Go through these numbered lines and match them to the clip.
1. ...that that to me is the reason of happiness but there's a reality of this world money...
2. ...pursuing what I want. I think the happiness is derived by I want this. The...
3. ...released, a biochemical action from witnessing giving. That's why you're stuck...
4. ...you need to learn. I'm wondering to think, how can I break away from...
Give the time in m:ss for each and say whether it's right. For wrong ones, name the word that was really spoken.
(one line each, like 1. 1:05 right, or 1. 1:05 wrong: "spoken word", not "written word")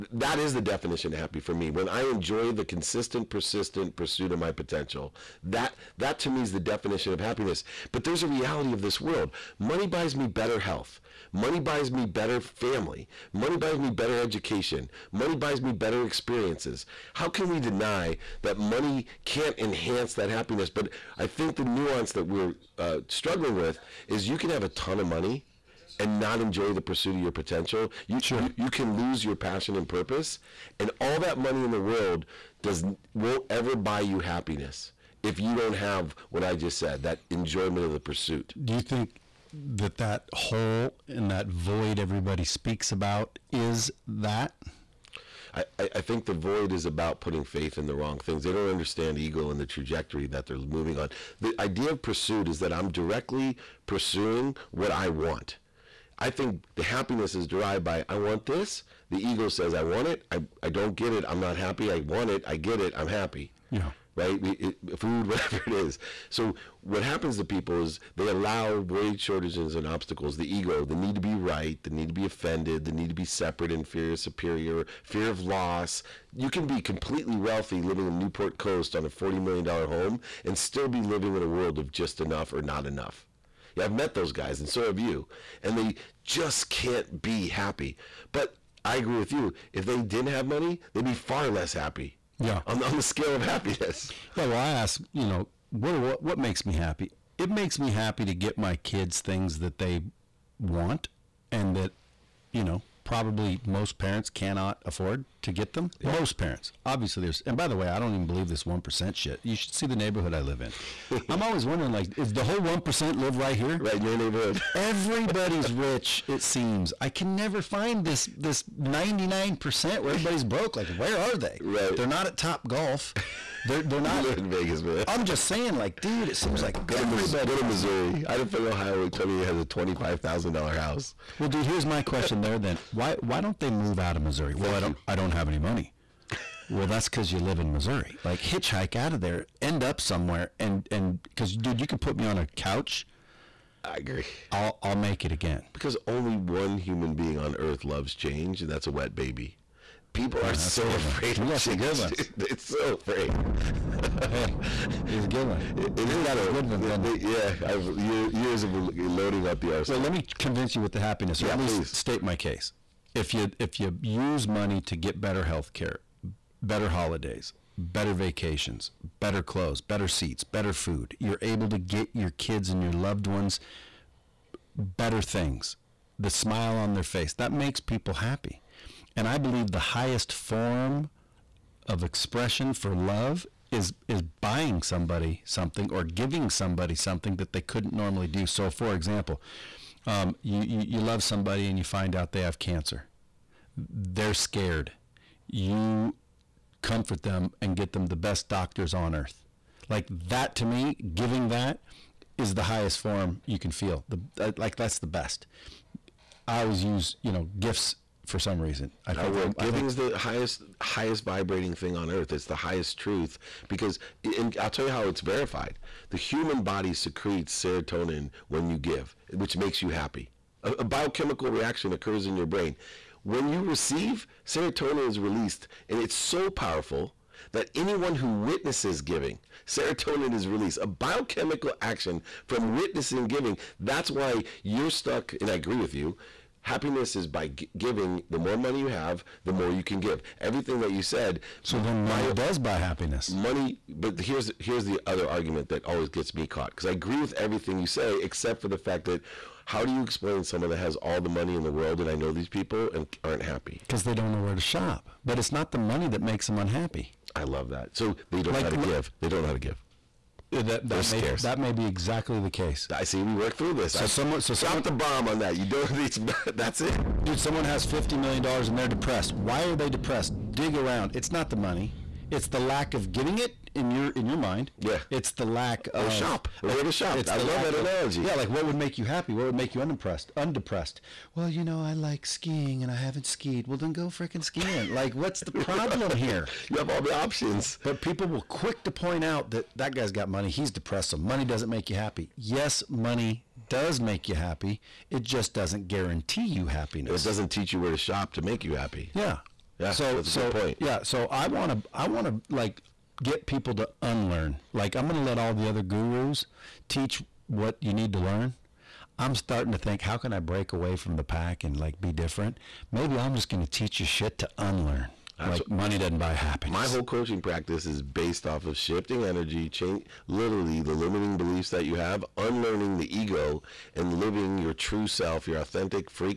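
1. 0:05 wrong: "definition", not "reason"
2. 0:53 right
3. 3:50 right
4. 5:07 wrong: "starting", not "wondering".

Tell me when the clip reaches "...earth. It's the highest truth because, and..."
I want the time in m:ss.
3:32.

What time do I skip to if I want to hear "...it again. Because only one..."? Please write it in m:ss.
2:25.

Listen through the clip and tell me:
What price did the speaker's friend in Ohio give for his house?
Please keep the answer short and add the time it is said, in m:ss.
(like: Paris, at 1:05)
$25,000, at 2:09.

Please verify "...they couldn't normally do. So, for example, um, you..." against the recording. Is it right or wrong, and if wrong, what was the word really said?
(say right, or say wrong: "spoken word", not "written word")
right.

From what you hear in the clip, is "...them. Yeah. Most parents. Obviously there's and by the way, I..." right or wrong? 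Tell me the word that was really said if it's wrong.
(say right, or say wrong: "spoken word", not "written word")
right.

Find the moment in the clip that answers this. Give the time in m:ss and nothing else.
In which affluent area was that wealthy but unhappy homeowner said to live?
1:18.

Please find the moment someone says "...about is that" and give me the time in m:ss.
0:42.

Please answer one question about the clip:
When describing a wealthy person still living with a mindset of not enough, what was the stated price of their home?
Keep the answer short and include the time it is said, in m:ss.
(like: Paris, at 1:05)
$40 million, at 1:19.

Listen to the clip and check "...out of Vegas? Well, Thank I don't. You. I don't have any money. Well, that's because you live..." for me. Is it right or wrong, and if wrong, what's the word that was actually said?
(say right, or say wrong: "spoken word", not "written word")
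wrong: "Missouri", not "Vegas".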